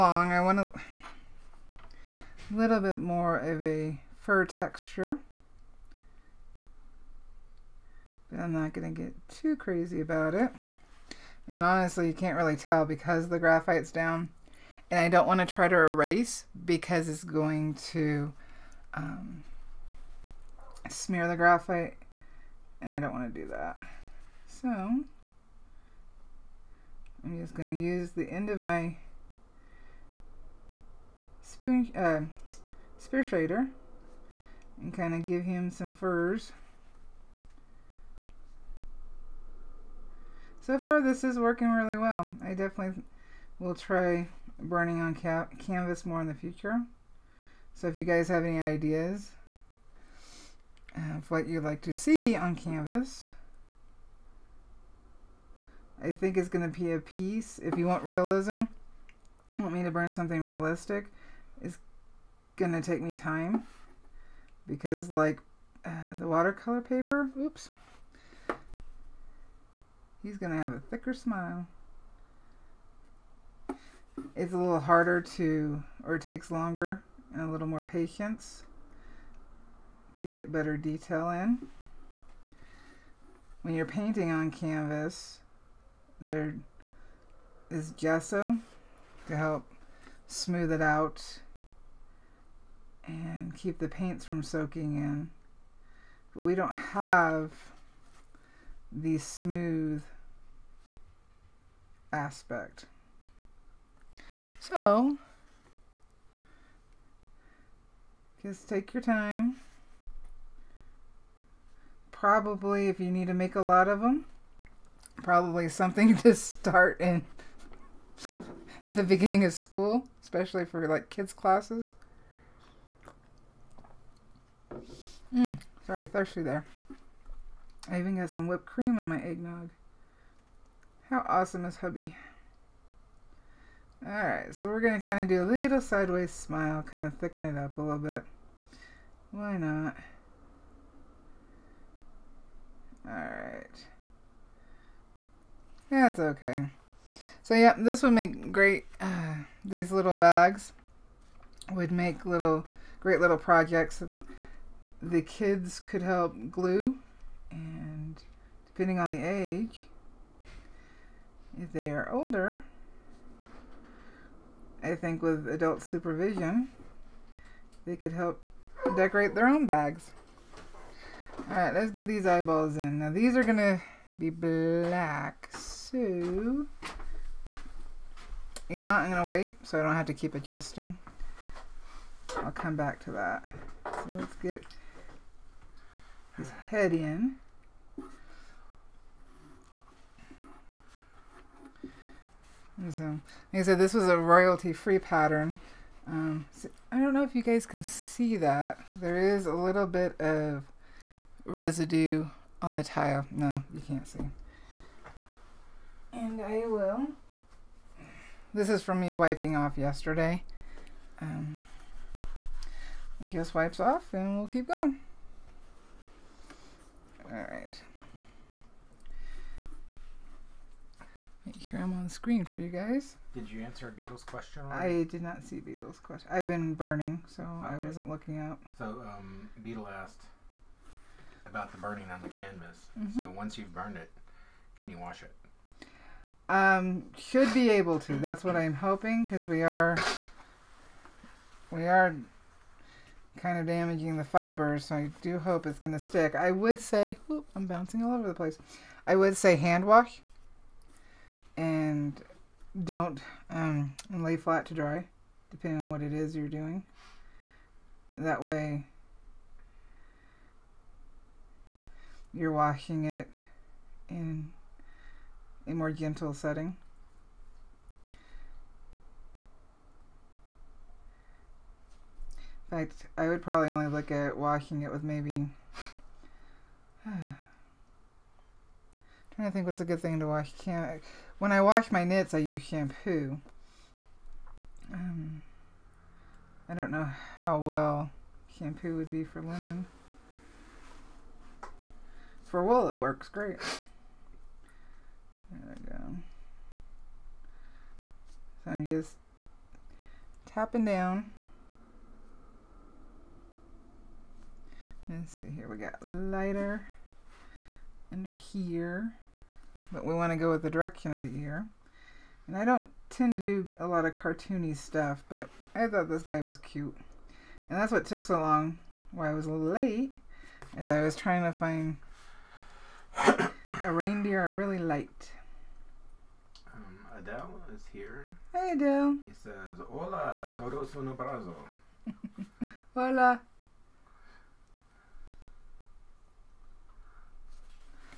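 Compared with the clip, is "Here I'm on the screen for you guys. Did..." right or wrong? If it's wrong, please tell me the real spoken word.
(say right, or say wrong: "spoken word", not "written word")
right.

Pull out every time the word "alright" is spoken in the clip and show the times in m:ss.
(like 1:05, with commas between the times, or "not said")
2:14, 2:23, 2:51.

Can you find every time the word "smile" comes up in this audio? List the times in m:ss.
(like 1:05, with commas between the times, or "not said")
1:11, 2:16.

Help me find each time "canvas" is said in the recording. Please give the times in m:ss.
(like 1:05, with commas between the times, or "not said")
0:45, 0:52, 1:24, 3:52.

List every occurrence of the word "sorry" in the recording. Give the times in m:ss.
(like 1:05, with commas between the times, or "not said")
2:05.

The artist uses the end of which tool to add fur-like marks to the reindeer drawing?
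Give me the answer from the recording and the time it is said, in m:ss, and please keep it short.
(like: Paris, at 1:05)
Spear shader, at 0:32.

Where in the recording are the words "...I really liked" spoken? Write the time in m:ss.
5:24.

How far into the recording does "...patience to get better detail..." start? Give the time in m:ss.
1:17.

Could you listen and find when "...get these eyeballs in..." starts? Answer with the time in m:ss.
2:51.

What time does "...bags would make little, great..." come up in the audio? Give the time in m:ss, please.
2:30.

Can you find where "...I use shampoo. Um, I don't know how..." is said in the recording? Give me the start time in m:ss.
4:42.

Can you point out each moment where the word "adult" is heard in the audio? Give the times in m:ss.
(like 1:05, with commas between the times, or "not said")
2:45.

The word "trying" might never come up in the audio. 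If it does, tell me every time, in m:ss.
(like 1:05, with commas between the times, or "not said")
4:37, 5:21.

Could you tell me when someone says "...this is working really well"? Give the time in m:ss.
0:41.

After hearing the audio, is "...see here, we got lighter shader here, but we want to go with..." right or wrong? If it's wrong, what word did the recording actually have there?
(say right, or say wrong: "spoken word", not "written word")
wrong: "under", not "shader".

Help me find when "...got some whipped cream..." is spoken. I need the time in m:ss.
2:08.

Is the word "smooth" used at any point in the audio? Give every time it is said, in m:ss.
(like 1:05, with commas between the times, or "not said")
1:30, 1:39.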